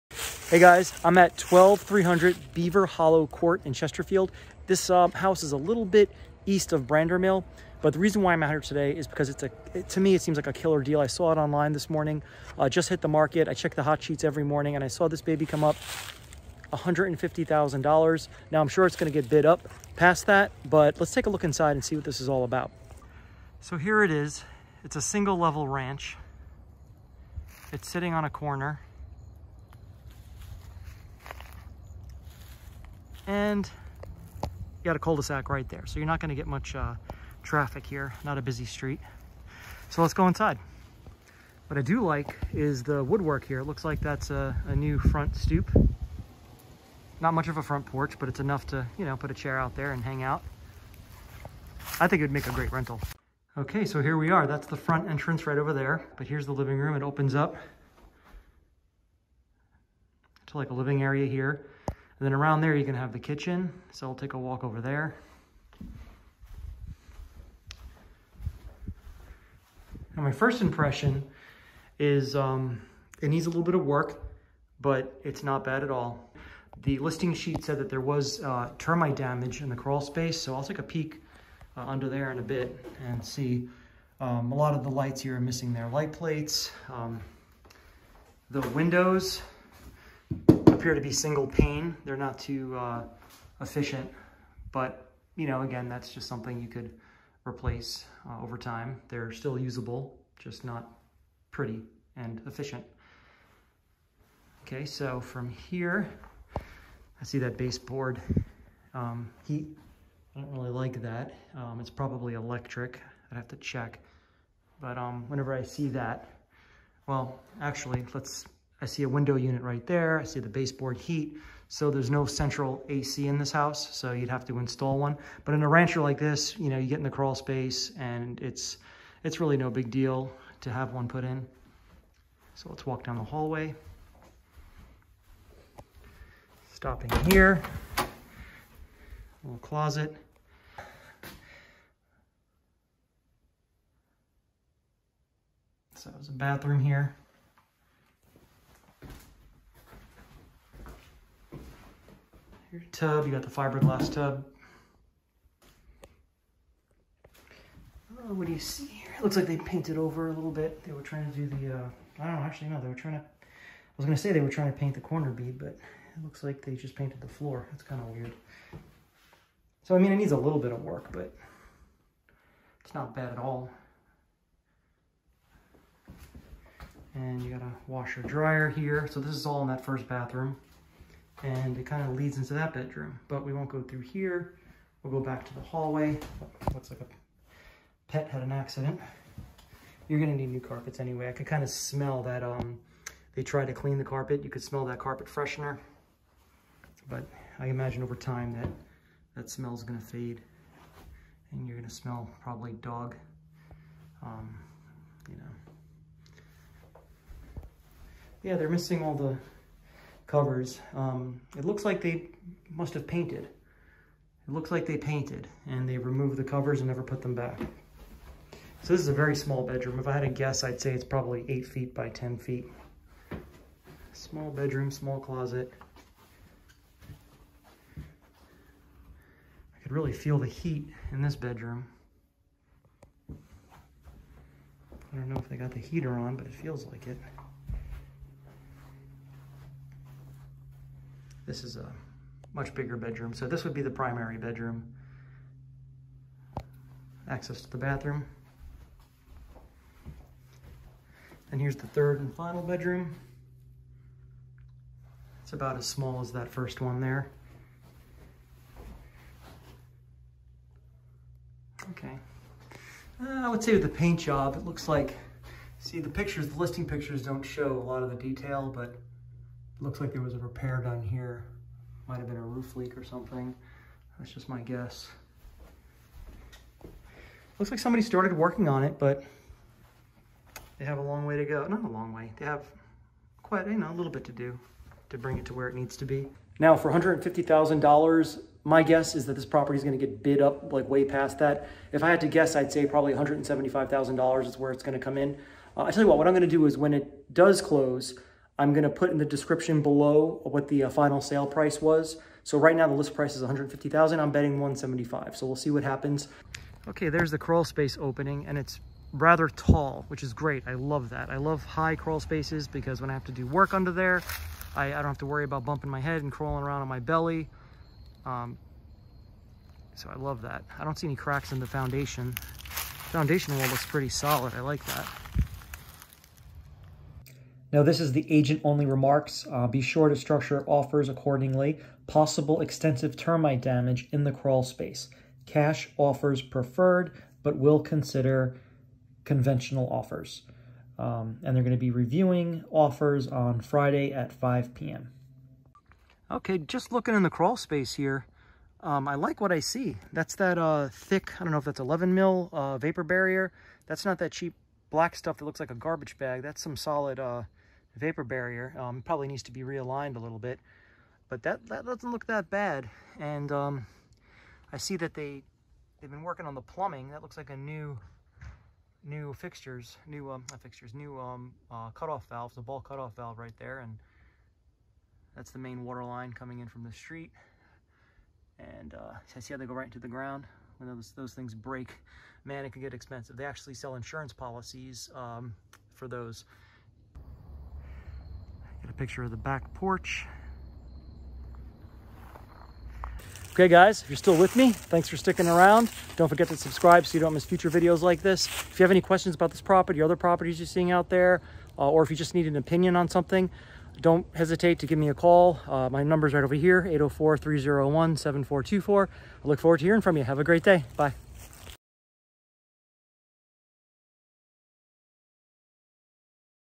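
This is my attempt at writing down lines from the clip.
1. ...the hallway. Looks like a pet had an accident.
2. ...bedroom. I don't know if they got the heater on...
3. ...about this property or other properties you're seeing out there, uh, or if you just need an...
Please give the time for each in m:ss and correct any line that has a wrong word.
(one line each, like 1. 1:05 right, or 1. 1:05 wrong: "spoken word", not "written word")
1. 3:05 right
2. 3:51 right
3. 6:39 right.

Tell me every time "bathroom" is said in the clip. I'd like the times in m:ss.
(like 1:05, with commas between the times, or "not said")
2:26, 3:00, 4:07.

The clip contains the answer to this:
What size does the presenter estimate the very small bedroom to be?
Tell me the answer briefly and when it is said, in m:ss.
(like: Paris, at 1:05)
8 feet by 10 feet, at 3:41.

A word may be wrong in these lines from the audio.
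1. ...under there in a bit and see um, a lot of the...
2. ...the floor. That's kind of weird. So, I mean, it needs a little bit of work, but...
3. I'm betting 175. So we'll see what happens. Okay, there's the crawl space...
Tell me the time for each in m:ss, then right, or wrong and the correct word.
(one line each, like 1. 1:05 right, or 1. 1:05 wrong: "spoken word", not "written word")
1. 1:21 right
2. 2:47 right
3. 5:04 right.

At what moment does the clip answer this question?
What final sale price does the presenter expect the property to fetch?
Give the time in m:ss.
4:53.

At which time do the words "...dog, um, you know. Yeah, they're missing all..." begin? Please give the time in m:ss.
3:22.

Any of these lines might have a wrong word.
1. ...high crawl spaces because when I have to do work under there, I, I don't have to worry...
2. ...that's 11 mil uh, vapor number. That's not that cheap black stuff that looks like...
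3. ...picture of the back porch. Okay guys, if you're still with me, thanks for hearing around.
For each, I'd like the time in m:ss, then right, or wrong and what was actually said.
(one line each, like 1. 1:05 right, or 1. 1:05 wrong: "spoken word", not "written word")
1. 5:11 right
2. 5:51 wrong: "barrier", not "number"
3. 6:28 wrong: "sticking", not "hearing".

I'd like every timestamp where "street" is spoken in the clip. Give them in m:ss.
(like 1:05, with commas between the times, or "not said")
0:38, 6:16.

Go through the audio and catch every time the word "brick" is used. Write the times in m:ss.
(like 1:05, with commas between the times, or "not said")
not said.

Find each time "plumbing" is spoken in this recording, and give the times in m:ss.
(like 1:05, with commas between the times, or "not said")
6:06.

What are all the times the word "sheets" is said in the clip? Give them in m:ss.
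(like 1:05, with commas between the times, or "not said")
0:14, 1:17.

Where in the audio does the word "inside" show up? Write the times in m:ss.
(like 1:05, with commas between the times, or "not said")
0:21, 0:40.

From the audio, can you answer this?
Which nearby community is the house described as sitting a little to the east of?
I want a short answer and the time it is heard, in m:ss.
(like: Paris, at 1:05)
Brandermill, at 0:06.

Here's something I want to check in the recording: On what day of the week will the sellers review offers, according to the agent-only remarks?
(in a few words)
Friday.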